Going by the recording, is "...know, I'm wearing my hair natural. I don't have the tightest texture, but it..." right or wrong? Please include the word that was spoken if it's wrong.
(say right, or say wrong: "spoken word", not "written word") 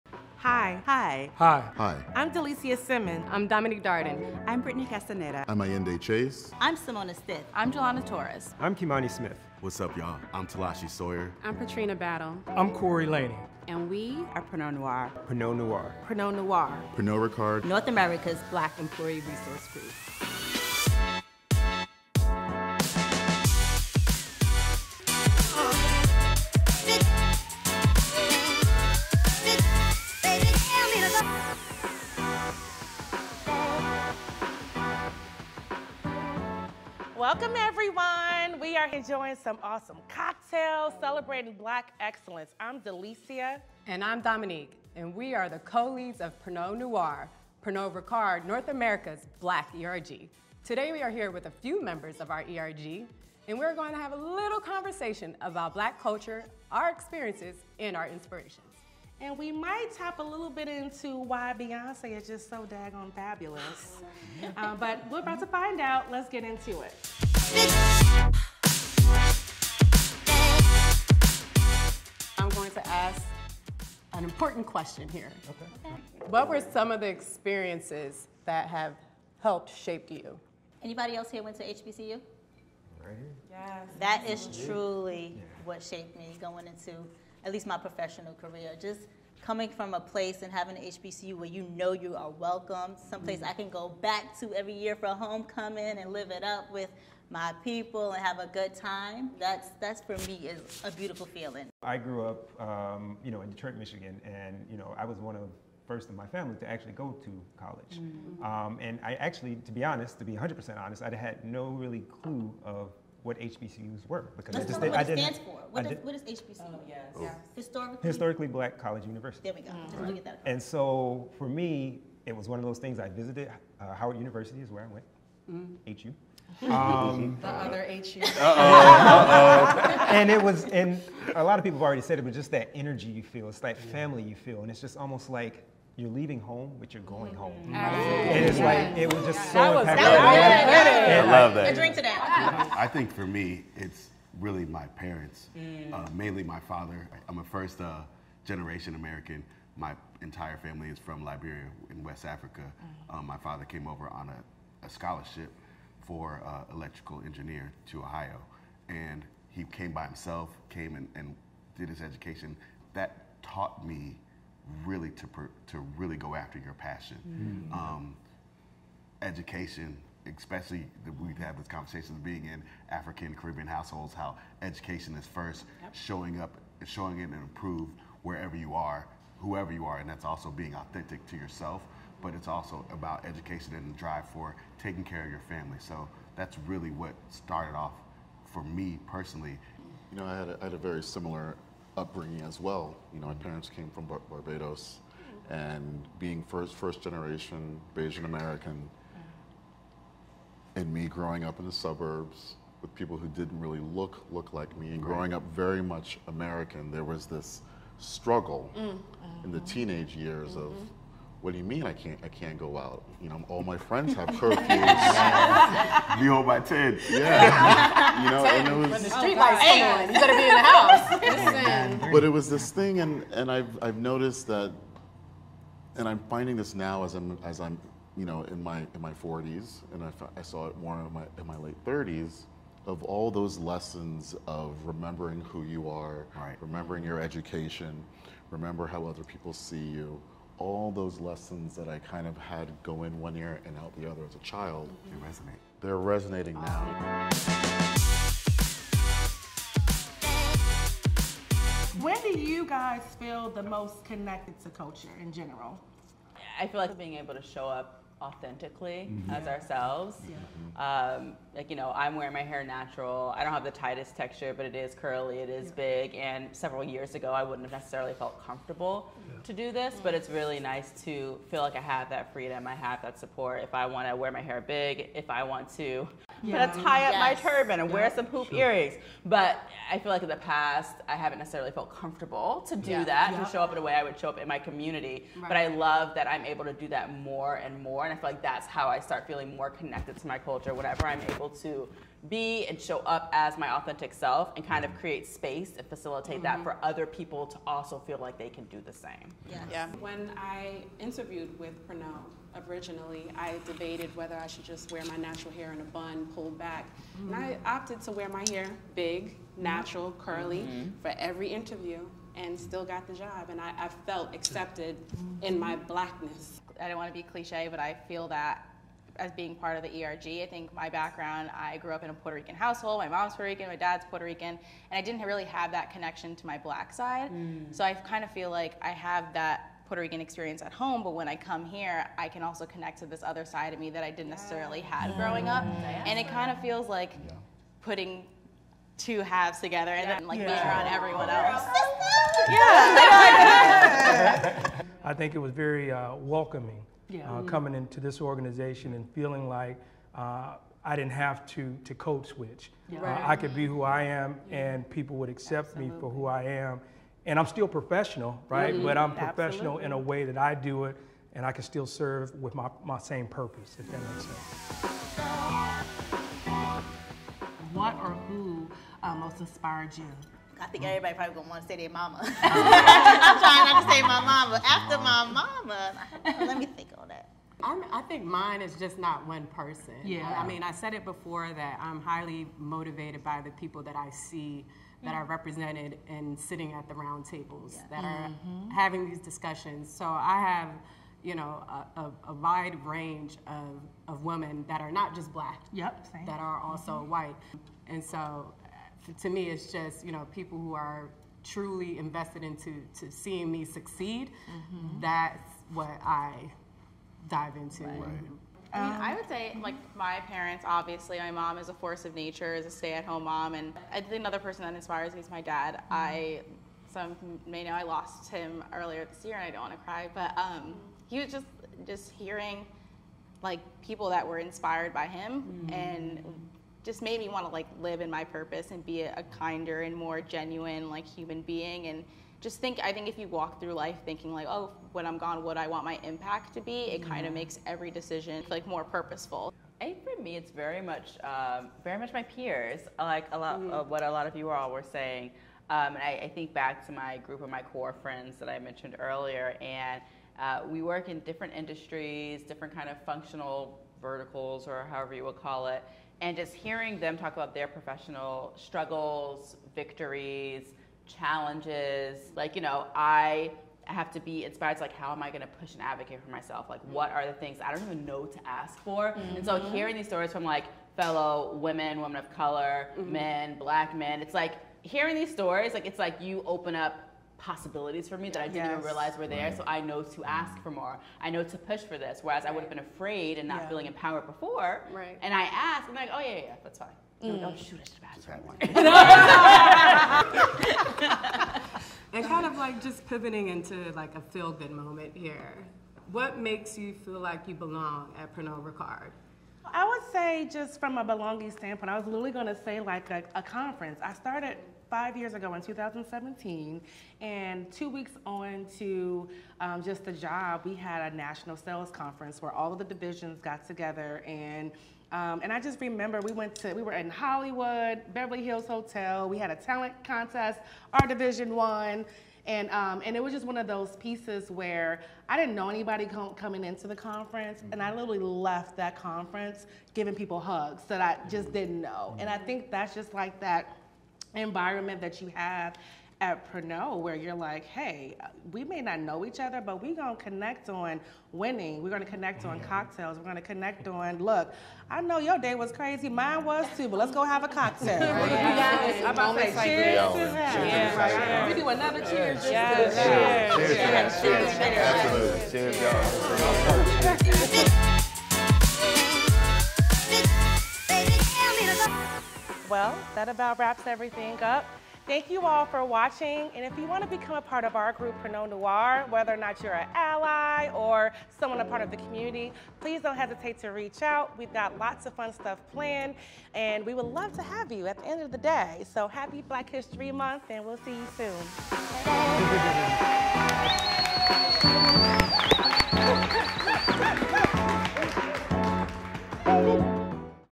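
right.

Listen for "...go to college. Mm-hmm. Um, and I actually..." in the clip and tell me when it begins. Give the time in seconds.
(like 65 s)
106 s.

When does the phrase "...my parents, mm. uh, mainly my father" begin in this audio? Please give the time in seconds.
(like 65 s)
144 s.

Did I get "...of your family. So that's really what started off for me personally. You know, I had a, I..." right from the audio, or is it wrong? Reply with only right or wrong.
right.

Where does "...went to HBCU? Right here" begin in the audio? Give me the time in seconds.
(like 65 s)
81 s.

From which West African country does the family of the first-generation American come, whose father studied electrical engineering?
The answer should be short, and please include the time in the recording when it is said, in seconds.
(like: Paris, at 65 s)
Liberia, at 151 s.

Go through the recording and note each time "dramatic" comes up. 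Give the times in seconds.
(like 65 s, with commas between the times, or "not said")
not said.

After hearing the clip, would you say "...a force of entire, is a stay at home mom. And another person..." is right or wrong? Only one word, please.
wrong.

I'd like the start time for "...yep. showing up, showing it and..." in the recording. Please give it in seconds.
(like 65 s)
175 s.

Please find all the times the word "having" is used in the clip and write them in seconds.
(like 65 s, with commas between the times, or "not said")
90 s, 388 s.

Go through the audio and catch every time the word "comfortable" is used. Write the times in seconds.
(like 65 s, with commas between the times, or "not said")
268 s, 281 s.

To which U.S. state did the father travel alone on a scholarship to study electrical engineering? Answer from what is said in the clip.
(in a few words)
Ohio.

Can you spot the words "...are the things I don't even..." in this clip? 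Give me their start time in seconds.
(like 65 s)
467 s.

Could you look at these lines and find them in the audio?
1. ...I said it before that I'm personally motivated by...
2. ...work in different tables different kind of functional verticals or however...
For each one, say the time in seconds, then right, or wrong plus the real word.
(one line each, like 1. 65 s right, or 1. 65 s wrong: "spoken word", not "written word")
1. 380 s wrong: "highly", not "personally"
2. 450 s wrong: "industries", not "tables".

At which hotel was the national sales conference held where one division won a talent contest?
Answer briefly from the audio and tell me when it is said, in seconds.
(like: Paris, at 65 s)
Beverly Hills Hotel, at 518 s.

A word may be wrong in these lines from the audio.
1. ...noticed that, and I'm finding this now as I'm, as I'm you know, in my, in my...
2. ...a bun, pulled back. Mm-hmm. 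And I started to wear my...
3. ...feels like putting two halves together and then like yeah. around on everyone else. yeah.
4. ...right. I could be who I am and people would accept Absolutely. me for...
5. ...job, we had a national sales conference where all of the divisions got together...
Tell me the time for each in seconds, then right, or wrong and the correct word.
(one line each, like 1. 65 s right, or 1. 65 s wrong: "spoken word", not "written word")
1. 223 s right
2. 305 s wrong: "opted", not "started"
3. 336 s right
4. 353 s right
5. 510 s right.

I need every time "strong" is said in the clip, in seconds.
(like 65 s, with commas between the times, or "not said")
not said.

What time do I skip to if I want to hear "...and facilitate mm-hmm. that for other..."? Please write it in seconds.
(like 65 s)
295 s.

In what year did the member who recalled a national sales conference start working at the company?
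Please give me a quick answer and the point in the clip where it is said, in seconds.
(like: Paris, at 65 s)
2017, at 505 s.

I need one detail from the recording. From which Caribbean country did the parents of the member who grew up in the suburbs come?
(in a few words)
Barbados.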